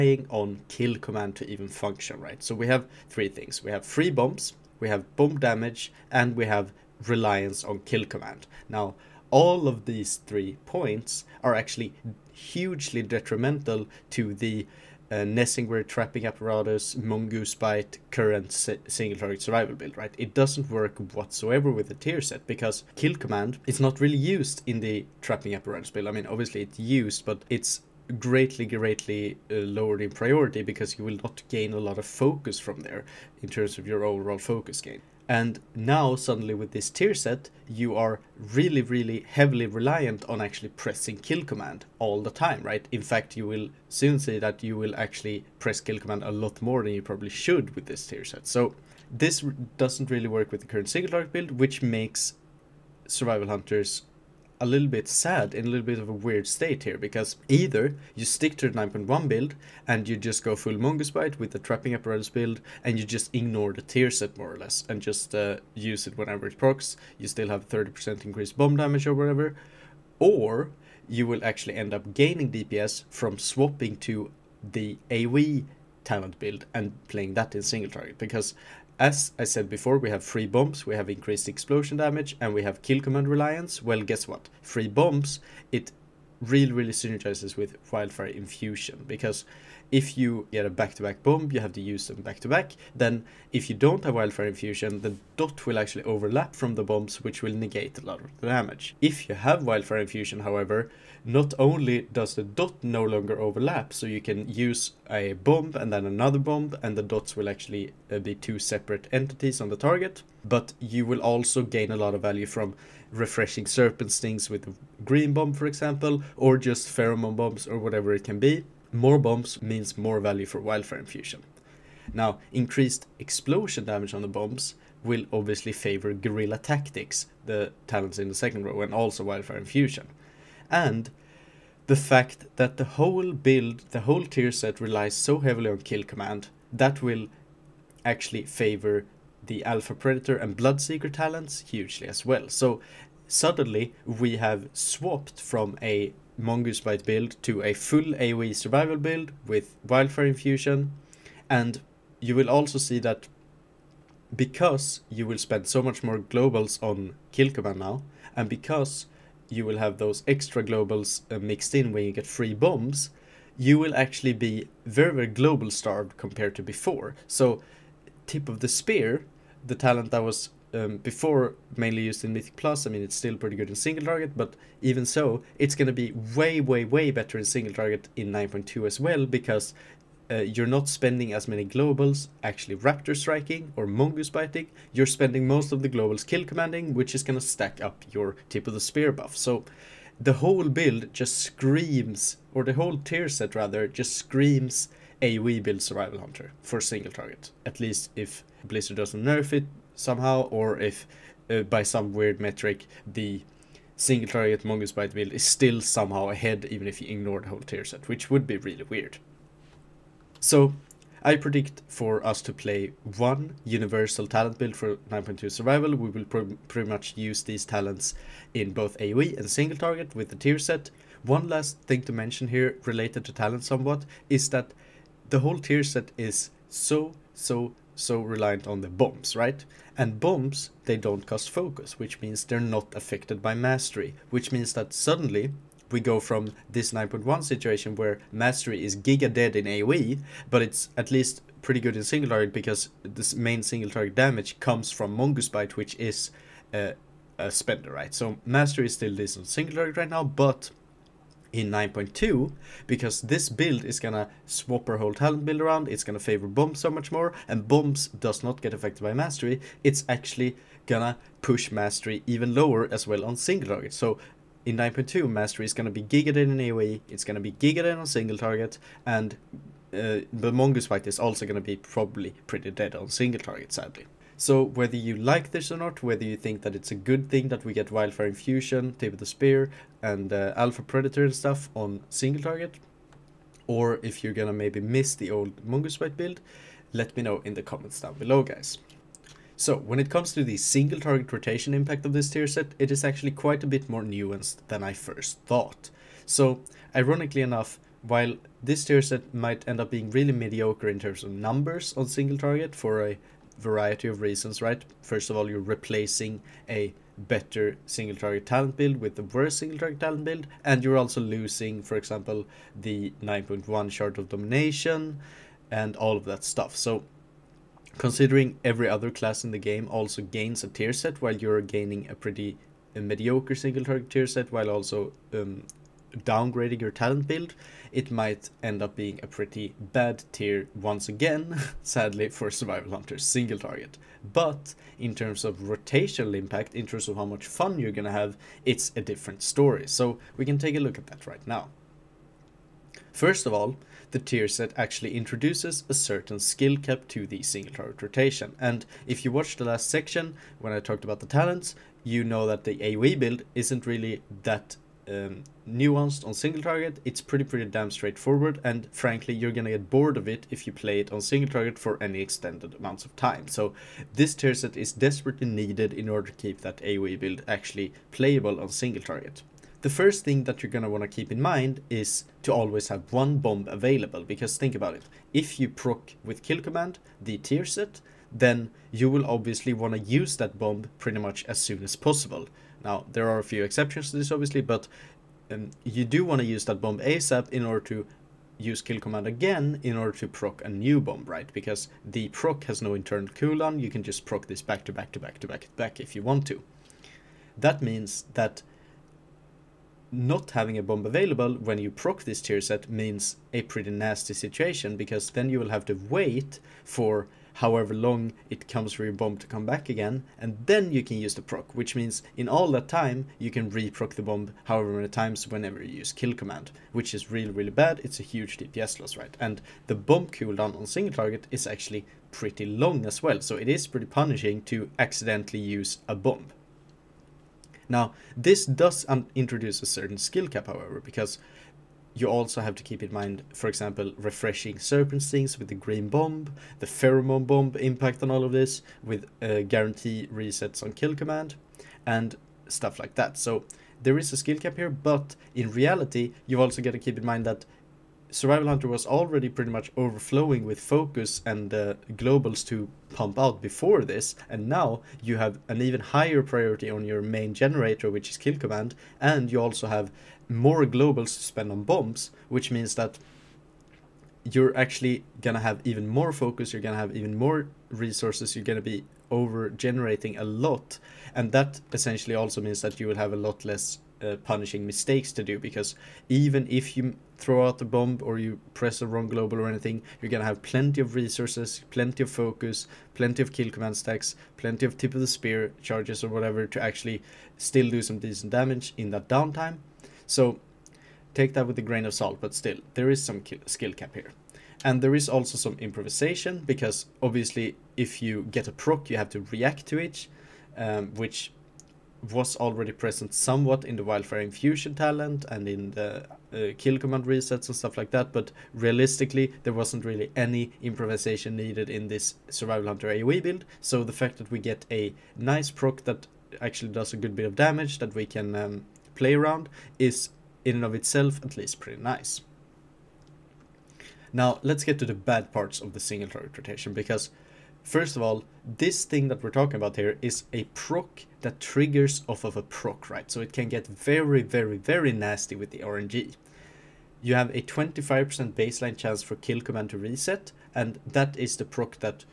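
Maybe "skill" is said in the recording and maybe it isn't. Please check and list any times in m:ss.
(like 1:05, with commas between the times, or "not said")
5:46, 7:10, 7:24, 8:13.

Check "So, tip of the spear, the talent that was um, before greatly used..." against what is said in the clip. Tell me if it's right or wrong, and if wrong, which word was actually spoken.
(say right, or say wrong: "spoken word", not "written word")
wrong: "mainly", not "greatly".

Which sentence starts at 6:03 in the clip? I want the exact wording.
So this tier set is desperately needed in order to keep that AoE build actually playable on single target.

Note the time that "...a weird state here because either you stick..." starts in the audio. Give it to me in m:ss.
0:56.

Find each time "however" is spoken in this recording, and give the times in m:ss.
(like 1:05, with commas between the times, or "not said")
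1:40, 6:47, 6:54, 7:10.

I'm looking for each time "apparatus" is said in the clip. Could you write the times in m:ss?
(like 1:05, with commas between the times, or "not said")
0:16, 0:25, 1:01.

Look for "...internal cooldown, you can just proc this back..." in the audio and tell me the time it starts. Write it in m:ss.
6:32.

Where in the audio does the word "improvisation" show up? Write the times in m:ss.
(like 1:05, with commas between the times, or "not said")
8:15, 8:30.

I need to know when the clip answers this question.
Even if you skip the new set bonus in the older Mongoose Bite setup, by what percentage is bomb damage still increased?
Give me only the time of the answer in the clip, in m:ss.
1:07.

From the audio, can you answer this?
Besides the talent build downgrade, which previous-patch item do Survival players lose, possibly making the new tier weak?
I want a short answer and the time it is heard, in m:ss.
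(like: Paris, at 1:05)
shard of domination, at 5:13.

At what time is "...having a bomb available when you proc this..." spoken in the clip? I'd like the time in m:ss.
6:40.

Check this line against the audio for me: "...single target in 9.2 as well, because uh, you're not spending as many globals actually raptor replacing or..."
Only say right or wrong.
wrong.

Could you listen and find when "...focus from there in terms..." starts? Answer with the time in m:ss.
0:32.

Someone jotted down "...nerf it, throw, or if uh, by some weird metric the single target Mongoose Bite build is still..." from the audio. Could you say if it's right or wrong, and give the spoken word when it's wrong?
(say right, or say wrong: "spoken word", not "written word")
wrong: "somehow", not "throw".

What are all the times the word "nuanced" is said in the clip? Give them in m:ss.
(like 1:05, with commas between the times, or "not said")
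4:54, 5:55.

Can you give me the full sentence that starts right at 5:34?
But in terms of rotational impact, in terms of how much fun you're gonna have, it's a different story.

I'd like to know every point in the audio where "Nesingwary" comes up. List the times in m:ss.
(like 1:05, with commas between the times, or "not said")
0:15.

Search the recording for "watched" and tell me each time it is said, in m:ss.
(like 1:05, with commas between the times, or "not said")
5:49.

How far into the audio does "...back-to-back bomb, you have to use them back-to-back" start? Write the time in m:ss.
1:30.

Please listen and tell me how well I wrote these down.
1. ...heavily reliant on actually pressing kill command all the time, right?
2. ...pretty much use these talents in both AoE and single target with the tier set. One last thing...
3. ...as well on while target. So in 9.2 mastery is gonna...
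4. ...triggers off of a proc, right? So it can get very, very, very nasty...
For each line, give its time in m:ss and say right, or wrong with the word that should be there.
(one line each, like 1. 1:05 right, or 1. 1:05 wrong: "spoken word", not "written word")
1. 0:39 right
2. 3:36 right
3. 4:22 wrong: "single", not "while"
4. 8:51 right.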